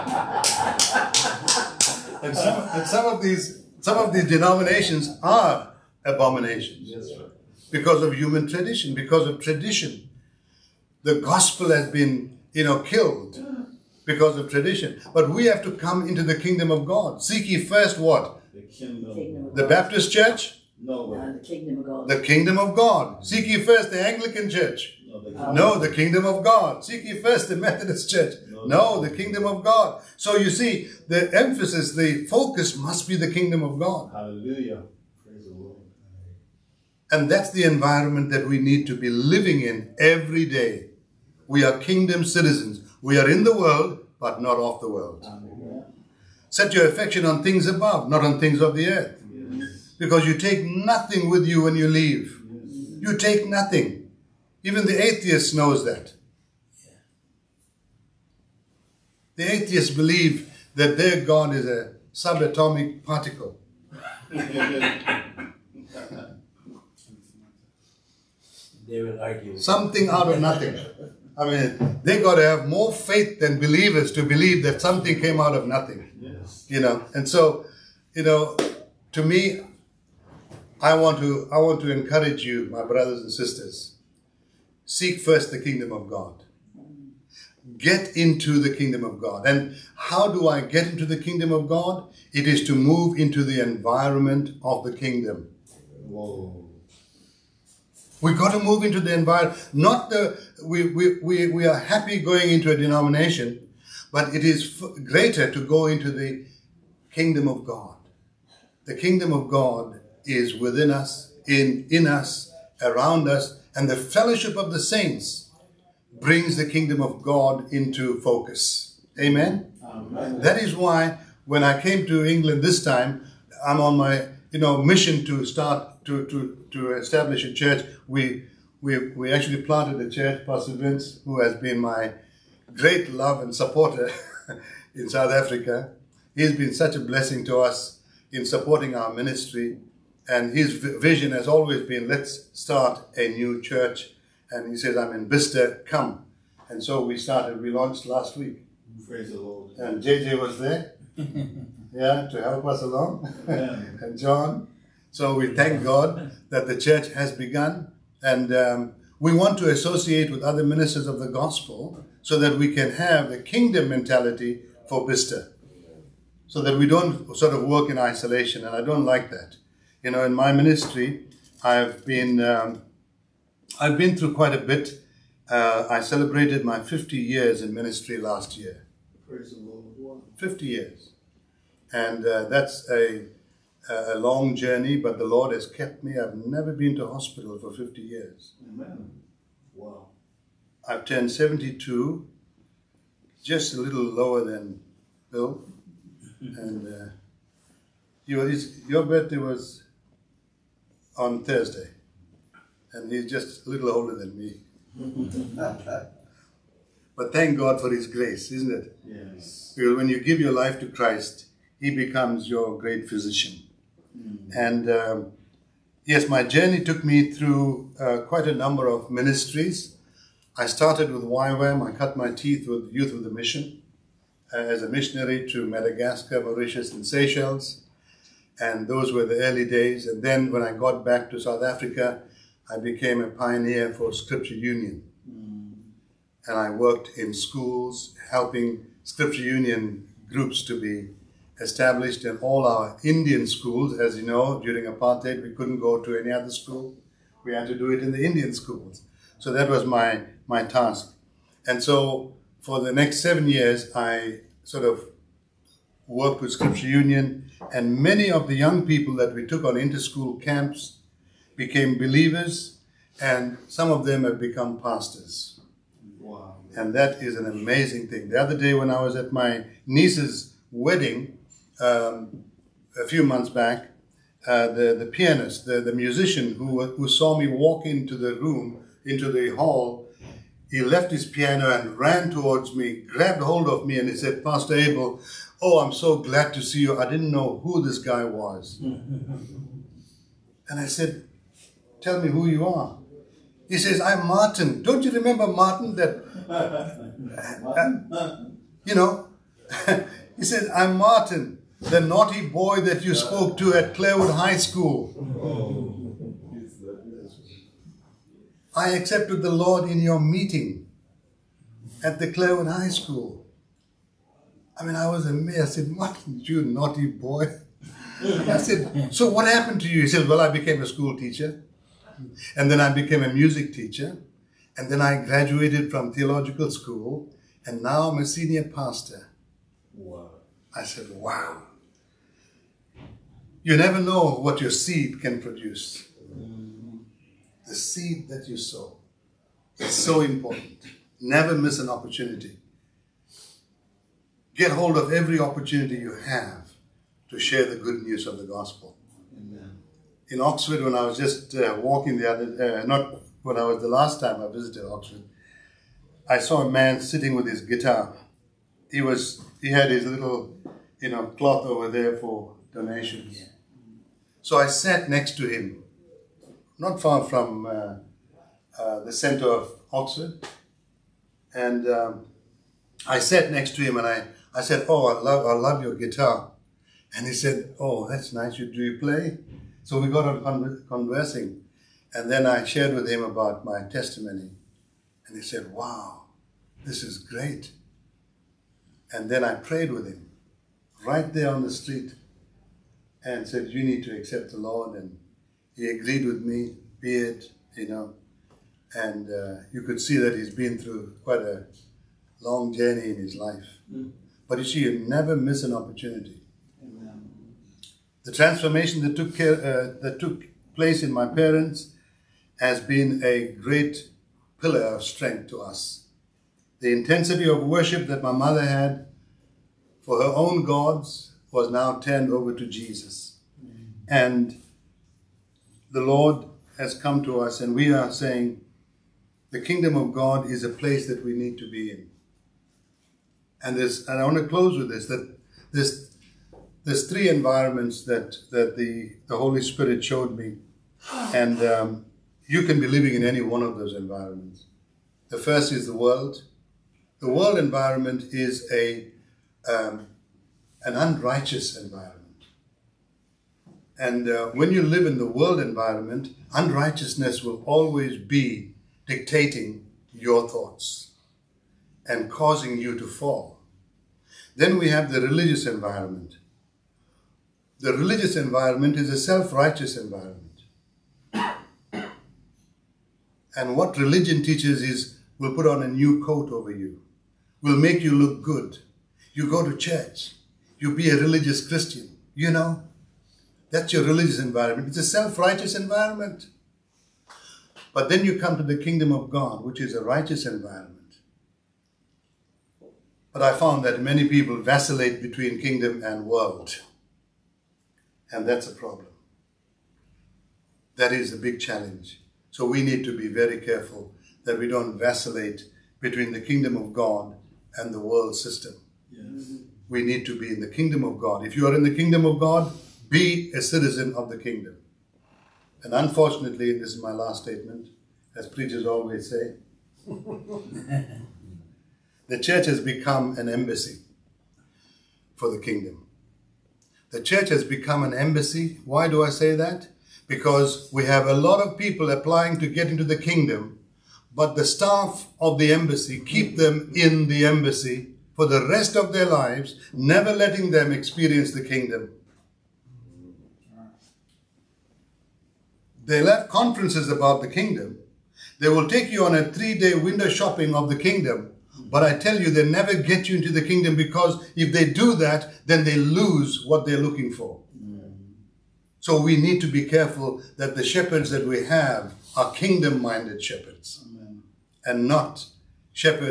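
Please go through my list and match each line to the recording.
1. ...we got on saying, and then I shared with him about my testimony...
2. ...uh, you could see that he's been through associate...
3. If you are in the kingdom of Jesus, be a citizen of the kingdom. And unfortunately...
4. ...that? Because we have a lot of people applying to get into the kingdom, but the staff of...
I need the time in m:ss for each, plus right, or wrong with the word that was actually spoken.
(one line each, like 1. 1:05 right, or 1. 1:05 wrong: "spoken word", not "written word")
1. 6:20 wrong: "conversing", not "saying"
2. 6:39 wrong: "quite", not "associate"
3. 8:31 wrong: "God", not "Jesus"
4. 8:49 right.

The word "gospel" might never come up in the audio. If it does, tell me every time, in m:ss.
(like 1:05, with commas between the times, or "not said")
0:11, 2:41, 5:48.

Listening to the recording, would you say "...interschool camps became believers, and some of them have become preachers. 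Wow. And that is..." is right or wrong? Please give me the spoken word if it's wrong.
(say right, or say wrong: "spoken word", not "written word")
wrong: "pastors", not "preachers".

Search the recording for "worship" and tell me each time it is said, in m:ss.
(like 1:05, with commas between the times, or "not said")
6:57.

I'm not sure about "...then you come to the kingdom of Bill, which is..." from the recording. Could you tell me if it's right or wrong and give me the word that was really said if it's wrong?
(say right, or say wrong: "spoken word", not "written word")
wrong: "God", not "Bill".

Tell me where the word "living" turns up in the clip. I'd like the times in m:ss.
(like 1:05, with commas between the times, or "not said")
0:39, 7:22.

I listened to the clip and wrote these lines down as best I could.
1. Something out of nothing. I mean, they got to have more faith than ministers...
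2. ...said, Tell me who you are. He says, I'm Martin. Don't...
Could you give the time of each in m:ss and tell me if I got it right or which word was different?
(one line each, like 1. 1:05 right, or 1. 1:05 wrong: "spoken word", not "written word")
1. 1:09 wrong: "believers", not "ministers"
2. 4:50 right.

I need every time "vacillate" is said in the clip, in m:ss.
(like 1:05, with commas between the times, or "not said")
8:14, 8:24.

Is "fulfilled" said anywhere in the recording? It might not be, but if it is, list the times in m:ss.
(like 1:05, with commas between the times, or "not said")
not said.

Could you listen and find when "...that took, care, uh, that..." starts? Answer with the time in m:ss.
6:49.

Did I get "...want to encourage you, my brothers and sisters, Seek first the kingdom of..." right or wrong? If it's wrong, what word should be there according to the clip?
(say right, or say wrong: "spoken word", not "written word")
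right.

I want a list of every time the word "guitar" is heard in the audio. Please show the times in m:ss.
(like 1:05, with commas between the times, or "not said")
5:57, 6:15.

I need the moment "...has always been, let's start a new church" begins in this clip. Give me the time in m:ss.
2:21.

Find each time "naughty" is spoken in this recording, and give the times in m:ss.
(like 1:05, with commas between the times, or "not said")
5:01, 5:16.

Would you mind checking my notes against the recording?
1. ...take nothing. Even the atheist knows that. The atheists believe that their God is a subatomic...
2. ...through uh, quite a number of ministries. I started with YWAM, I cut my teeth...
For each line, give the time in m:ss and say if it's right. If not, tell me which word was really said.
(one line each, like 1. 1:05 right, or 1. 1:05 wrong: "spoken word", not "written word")
1. 0:53 right
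2. 3:37 right.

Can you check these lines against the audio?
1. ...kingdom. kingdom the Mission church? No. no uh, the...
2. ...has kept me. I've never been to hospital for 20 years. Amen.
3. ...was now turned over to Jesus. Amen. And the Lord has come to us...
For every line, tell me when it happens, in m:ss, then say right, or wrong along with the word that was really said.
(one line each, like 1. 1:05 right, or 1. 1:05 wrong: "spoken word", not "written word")
1. 0:18 wrong: "Baptist", not "Mission"
2. 3:05 wrong: "50", not "20"
3. 7:01 right.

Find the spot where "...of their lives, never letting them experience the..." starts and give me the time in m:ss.
8:58.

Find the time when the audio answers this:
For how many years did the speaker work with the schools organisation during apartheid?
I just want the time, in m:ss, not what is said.
4:13.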